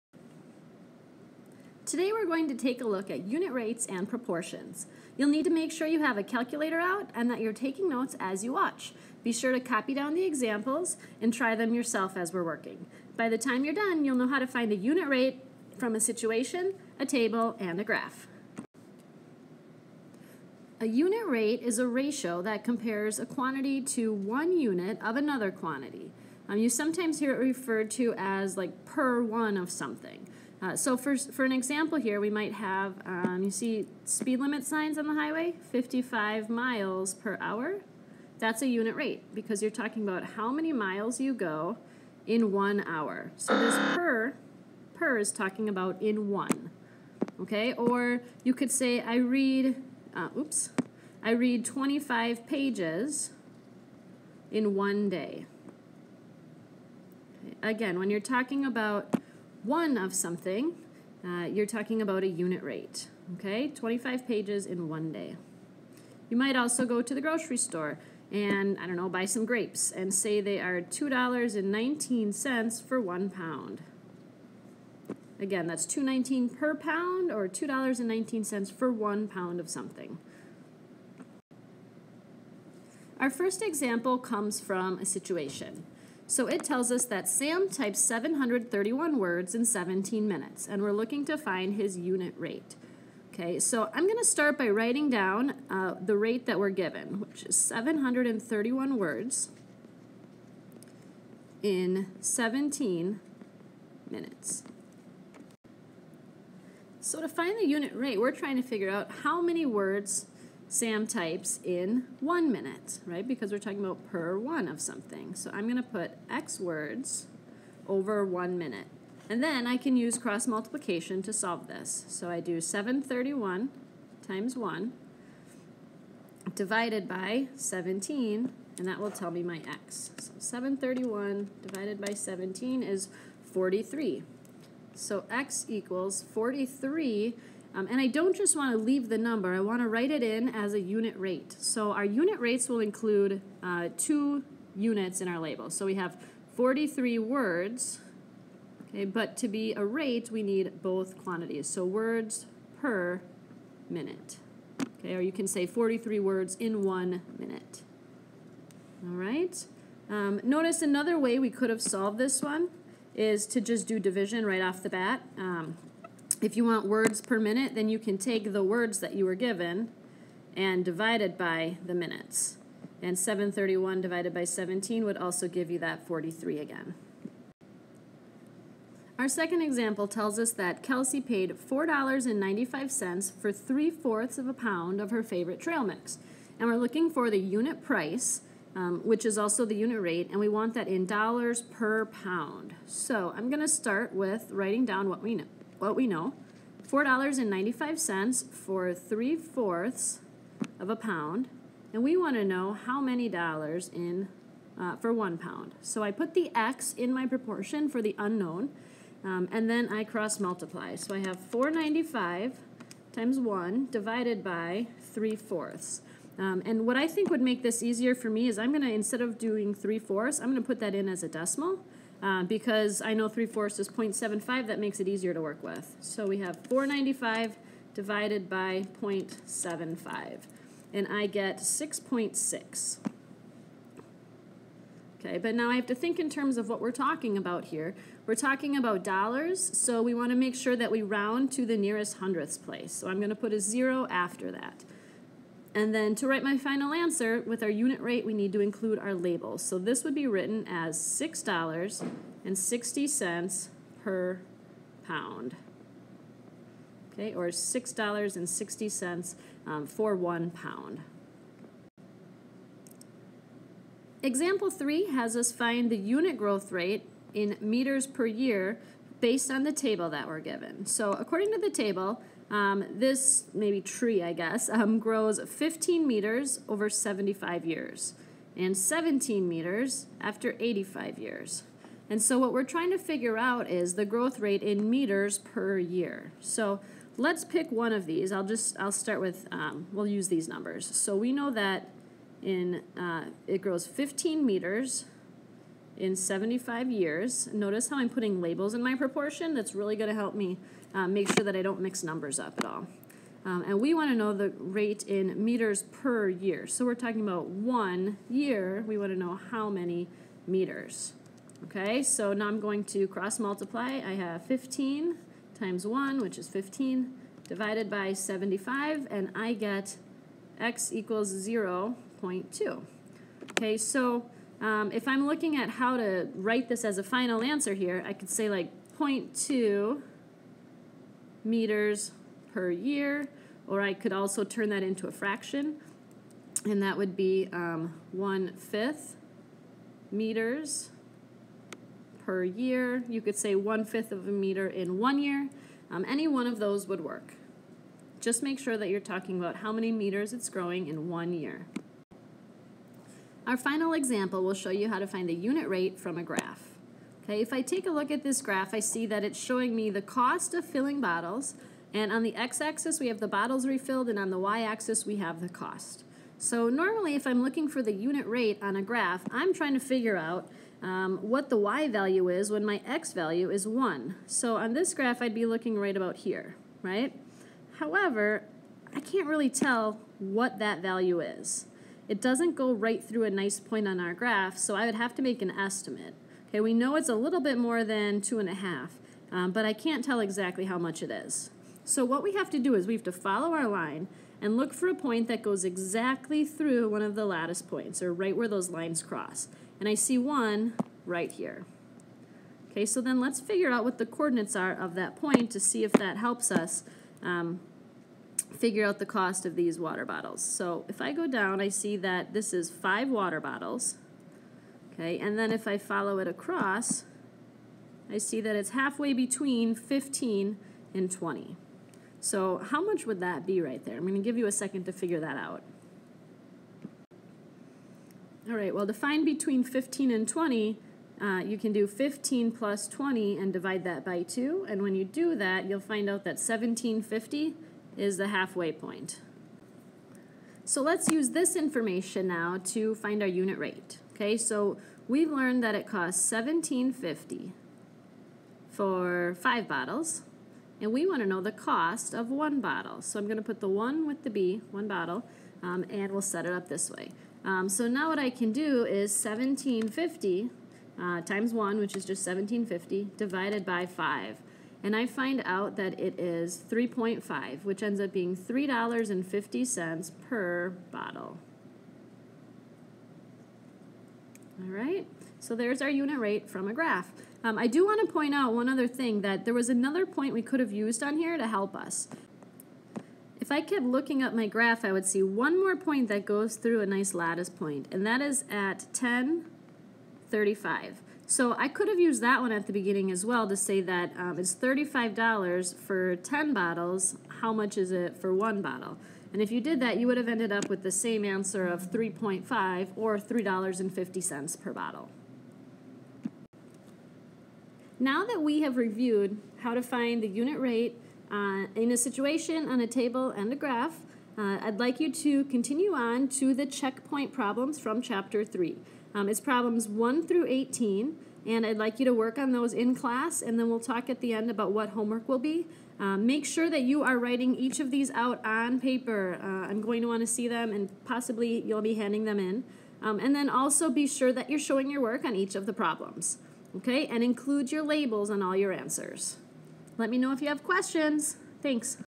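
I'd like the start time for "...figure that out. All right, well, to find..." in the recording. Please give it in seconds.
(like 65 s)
424 s.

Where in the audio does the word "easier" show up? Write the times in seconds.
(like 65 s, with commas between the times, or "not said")
217 s, 225 s.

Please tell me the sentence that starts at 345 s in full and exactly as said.
Um, any one of those would work.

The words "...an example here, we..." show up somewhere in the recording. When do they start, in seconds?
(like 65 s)
31 s.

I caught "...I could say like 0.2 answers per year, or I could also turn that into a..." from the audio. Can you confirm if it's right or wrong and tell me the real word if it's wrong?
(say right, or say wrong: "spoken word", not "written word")
wrong: "meters", not "answers".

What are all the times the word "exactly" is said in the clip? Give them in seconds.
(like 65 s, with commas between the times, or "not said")
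390 s, 395 s.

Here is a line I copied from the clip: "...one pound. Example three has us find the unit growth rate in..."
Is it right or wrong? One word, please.
right.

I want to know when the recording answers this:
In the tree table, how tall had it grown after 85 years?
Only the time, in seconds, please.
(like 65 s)
278 s.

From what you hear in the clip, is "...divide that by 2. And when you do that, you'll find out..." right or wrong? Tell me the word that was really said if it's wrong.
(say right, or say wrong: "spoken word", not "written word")
right.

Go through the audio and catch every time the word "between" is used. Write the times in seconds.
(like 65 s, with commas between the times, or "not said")
419 s, 429 s.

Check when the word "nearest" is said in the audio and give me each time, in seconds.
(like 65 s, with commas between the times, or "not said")
241 s.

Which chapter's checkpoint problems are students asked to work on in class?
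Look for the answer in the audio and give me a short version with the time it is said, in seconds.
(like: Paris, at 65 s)
Chapter 3, at 518 s.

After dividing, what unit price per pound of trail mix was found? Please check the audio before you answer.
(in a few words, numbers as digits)
$6.60 per pound.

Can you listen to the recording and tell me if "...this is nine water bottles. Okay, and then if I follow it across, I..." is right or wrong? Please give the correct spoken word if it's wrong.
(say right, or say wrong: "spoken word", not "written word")
wrong: "five", not "nine".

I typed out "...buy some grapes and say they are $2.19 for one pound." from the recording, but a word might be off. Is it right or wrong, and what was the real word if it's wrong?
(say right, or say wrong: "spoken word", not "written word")
right.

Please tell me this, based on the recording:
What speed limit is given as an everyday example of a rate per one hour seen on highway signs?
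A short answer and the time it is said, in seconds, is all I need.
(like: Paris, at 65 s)
55 miles per hour, at 35 s.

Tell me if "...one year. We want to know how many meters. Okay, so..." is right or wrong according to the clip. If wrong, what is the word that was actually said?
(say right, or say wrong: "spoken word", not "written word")
right.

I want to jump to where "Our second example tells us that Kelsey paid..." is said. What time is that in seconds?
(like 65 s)
179 s.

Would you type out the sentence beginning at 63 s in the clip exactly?
Okay, 25 pages in one day.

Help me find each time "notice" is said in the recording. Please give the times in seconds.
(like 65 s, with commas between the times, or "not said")
160 s, 297 s.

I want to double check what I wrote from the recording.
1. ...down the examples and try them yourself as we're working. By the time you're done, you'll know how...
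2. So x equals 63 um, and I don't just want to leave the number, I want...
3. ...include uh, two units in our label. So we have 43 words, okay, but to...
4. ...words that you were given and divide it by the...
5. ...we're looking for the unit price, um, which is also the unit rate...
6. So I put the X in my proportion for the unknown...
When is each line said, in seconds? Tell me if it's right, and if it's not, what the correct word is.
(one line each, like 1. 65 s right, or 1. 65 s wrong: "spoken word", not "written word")
1. 9 s right
2. 134 s wrong: "43", not "63"
3. 142 s right
4. 168 s right
5. 186 s right
6. 205 s right.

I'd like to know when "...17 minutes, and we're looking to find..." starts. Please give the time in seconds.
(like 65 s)
89 s.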